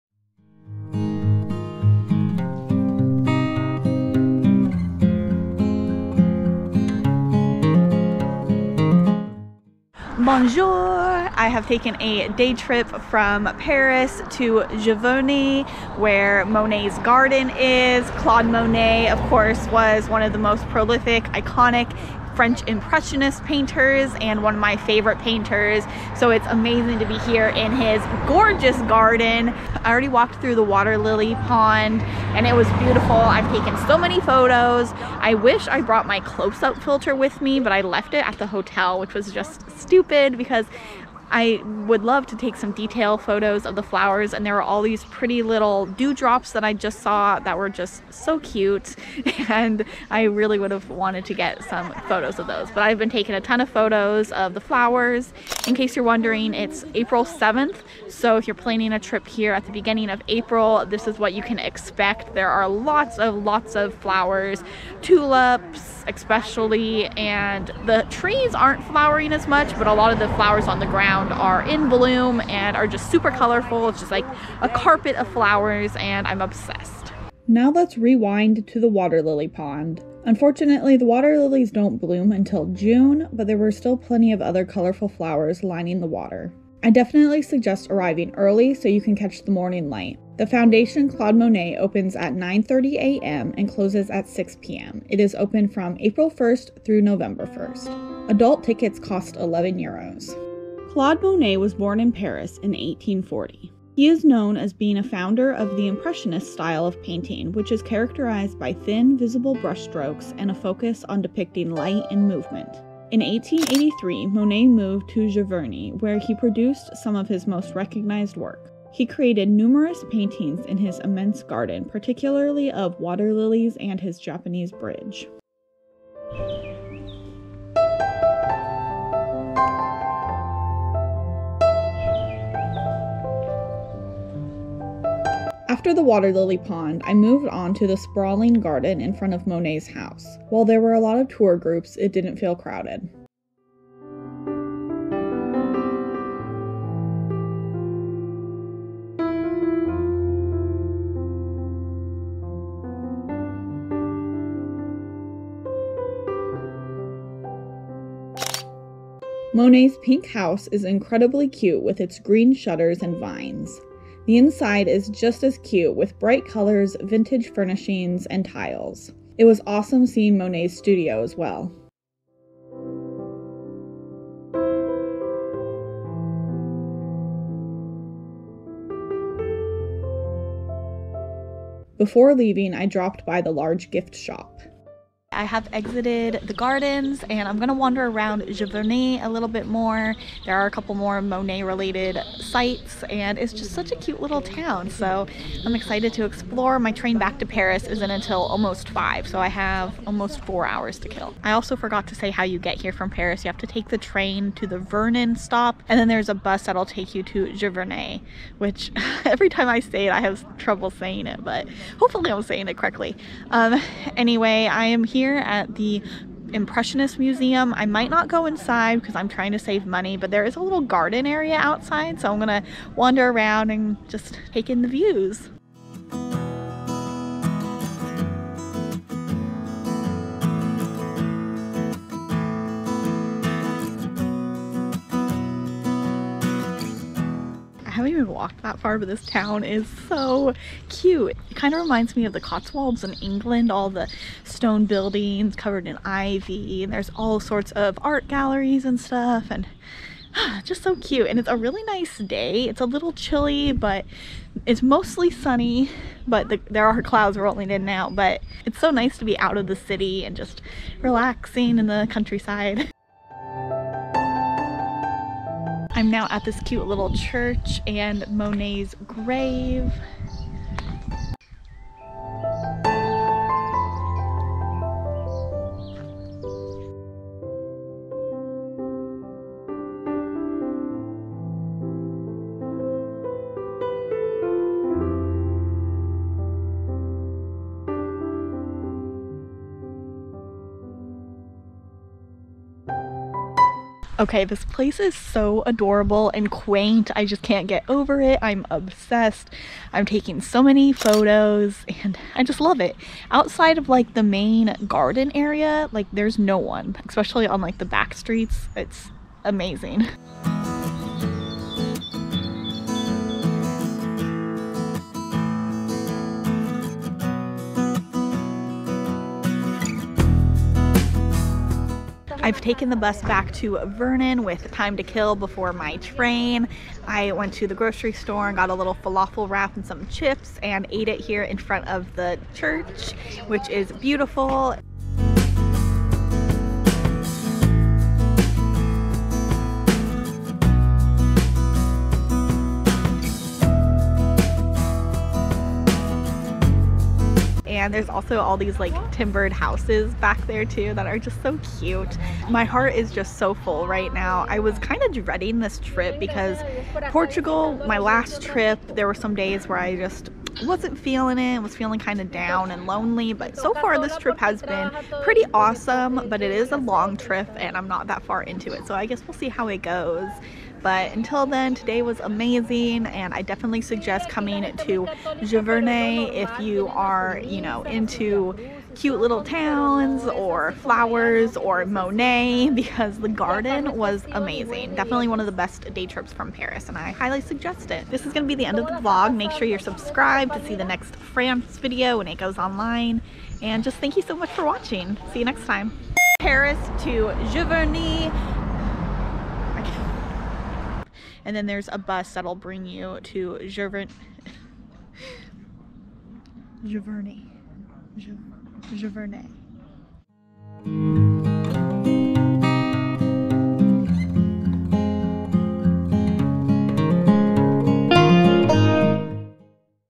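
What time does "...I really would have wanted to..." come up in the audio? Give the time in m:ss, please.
0:50.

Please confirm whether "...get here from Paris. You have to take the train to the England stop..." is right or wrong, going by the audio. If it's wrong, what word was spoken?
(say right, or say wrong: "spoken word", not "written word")
wrong: "Vernon", not "England".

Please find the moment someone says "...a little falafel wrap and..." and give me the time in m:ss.
5:28.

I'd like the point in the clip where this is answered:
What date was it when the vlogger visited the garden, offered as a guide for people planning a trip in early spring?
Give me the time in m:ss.
0:56.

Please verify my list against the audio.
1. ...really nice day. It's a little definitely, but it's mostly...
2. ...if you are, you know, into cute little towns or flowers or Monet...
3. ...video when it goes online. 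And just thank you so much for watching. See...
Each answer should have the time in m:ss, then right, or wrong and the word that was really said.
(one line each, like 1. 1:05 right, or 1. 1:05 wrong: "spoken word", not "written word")
1. 4:11 wrong: "chilly", not "definitely"
2. 6:16 right
3. 6:31 right.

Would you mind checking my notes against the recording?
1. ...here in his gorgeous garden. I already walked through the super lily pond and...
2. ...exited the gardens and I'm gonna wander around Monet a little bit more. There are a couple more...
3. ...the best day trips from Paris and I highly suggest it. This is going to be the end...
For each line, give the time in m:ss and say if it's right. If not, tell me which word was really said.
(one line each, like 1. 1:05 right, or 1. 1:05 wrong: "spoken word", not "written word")
1. 0:27 wrong: "water", not "super"
2. 3:05 wrong: "Giverny", not "Monet"
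3. 6:25 right.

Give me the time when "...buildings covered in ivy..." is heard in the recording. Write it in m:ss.
4:04.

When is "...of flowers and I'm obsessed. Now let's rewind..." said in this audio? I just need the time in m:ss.
1:15.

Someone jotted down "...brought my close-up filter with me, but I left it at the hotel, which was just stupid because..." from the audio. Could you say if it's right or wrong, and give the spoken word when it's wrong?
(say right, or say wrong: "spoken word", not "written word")
right.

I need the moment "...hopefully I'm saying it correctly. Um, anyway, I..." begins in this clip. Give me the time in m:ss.
3:32.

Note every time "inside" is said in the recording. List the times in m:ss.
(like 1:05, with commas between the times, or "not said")
2:44, 3:38.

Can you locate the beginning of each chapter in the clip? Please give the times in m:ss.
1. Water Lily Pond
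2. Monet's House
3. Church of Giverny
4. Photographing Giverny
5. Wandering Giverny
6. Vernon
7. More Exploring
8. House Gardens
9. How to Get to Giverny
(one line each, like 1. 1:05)
1. 1:17
2. 2:38
3. 4:23
4. 4:52
5. 3:05
6. 5:22
7. 3:33
8. 2:15
9. 3:21.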